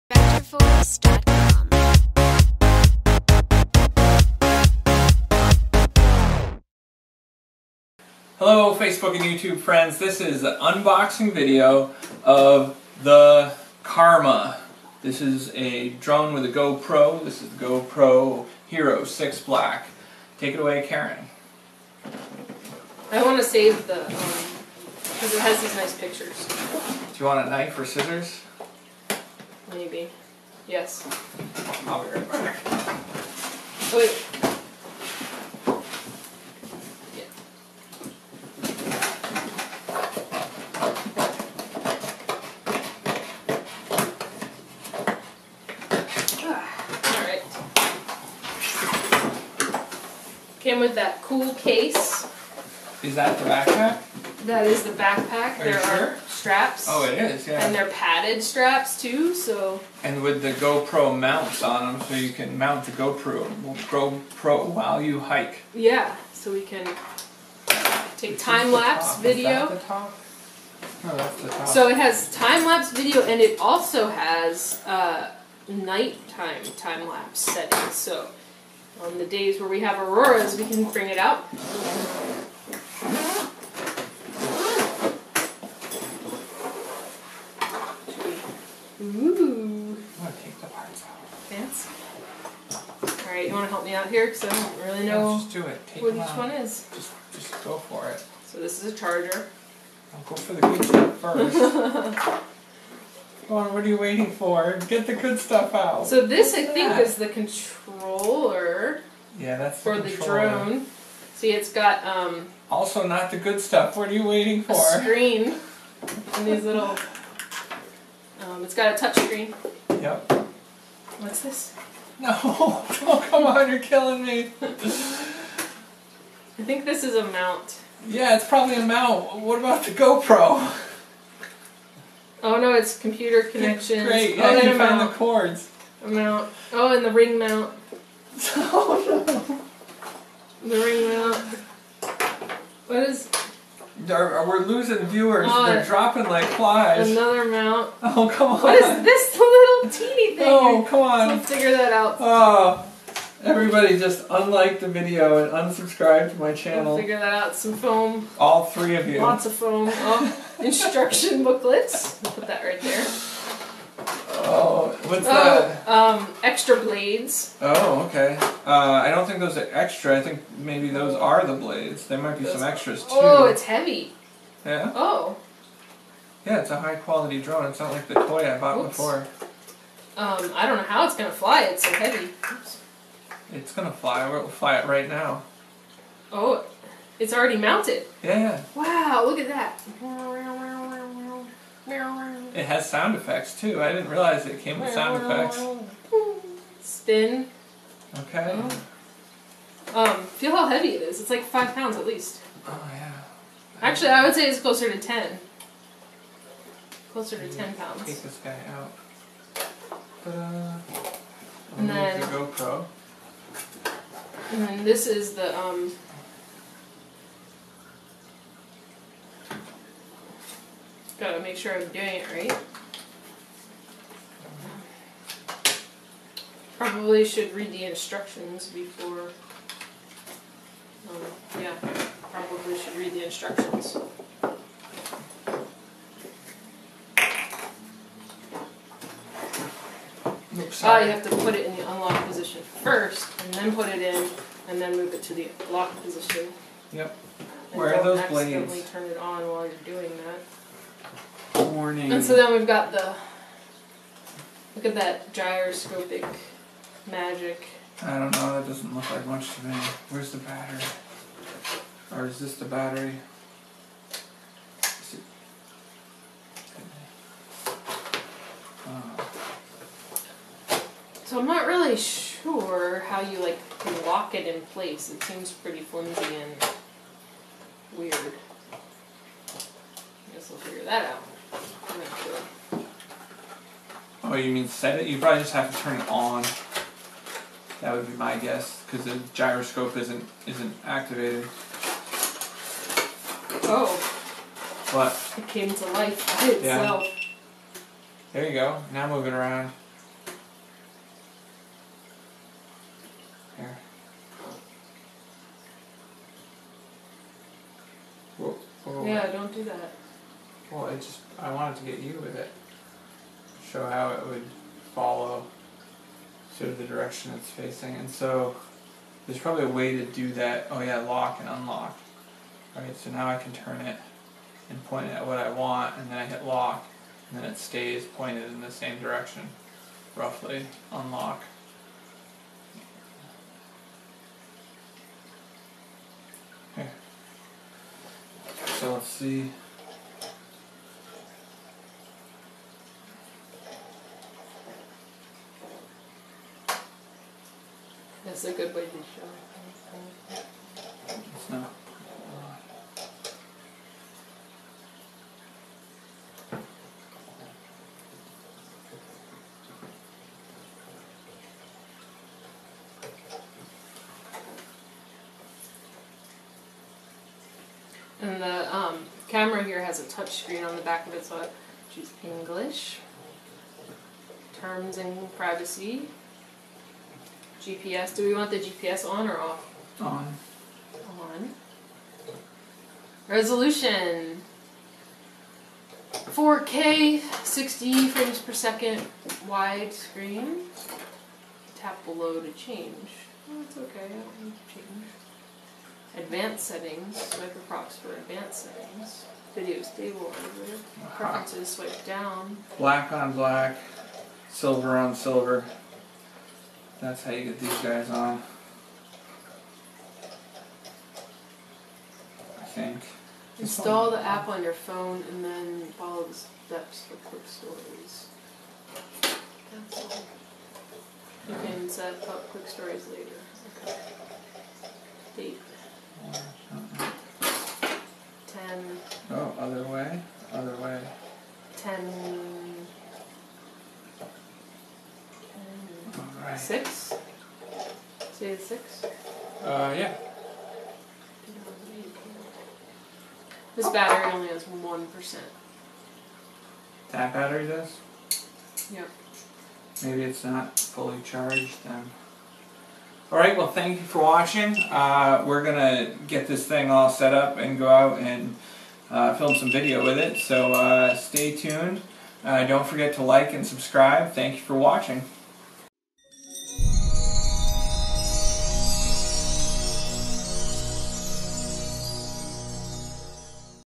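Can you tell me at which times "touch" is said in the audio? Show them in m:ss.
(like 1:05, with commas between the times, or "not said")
1:58, 6:10.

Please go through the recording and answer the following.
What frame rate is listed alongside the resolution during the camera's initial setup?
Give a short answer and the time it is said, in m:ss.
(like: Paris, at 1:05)
60 frames per second, at 6:27.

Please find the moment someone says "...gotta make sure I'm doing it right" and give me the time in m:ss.
3:41.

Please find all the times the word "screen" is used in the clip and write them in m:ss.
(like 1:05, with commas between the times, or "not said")
1:55, 1:59, 6:10, 6:29.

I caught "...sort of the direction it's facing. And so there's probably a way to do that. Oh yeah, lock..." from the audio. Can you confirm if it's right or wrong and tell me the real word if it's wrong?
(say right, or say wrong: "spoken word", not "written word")
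right.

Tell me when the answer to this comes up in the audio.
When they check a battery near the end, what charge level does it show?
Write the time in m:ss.
7:24.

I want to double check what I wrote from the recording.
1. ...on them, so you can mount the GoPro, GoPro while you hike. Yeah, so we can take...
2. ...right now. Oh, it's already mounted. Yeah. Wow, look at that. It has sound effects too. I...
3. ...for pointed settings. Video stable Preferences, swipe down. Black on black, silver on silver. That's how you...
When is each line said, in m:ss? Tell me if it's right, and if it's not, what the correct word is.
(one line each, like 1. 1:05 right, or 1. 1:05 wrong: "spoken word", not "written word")
1. 1:01 right
2. 3:04 right
3. 6:37 wrong: "advanced", not "pointed".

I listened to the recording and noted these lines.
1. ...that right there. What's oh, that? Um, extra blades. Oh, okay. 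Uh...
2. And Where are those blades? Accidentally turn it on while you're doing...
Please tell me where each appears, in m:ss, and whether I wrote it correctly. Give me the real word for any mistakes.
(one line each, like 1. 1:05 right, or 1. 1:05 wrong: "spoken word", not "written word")
1. 2:42 right
2. 4:07 right.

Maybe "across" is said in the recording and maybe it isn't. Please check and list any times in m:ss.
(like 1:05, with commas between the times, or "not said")
6:37.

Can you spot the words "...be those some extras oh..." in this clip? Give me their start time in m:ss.
2:52.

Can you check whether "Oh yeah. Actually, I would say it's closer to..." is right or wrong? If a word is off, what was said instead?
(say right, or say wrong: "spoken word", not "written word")
right.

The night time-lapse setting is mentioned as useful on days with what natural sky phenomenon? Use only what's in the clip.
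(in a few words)
Auroras.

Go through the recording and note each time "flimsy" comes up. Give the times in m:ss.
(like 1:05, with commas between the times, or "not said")
4:35.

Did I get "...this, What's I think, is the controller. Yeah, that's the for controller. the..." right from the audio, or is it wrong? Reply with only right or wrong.
right.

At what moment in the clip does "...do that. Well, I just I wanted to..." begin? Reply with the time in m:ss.
5:09.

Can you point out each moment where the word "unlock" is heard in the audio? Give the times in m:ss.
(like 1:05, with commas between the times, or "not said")
4:01, 5:21, 5:30.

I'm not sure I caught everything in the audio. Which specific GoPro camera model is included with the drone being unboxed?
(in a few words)
Hero 6 Black.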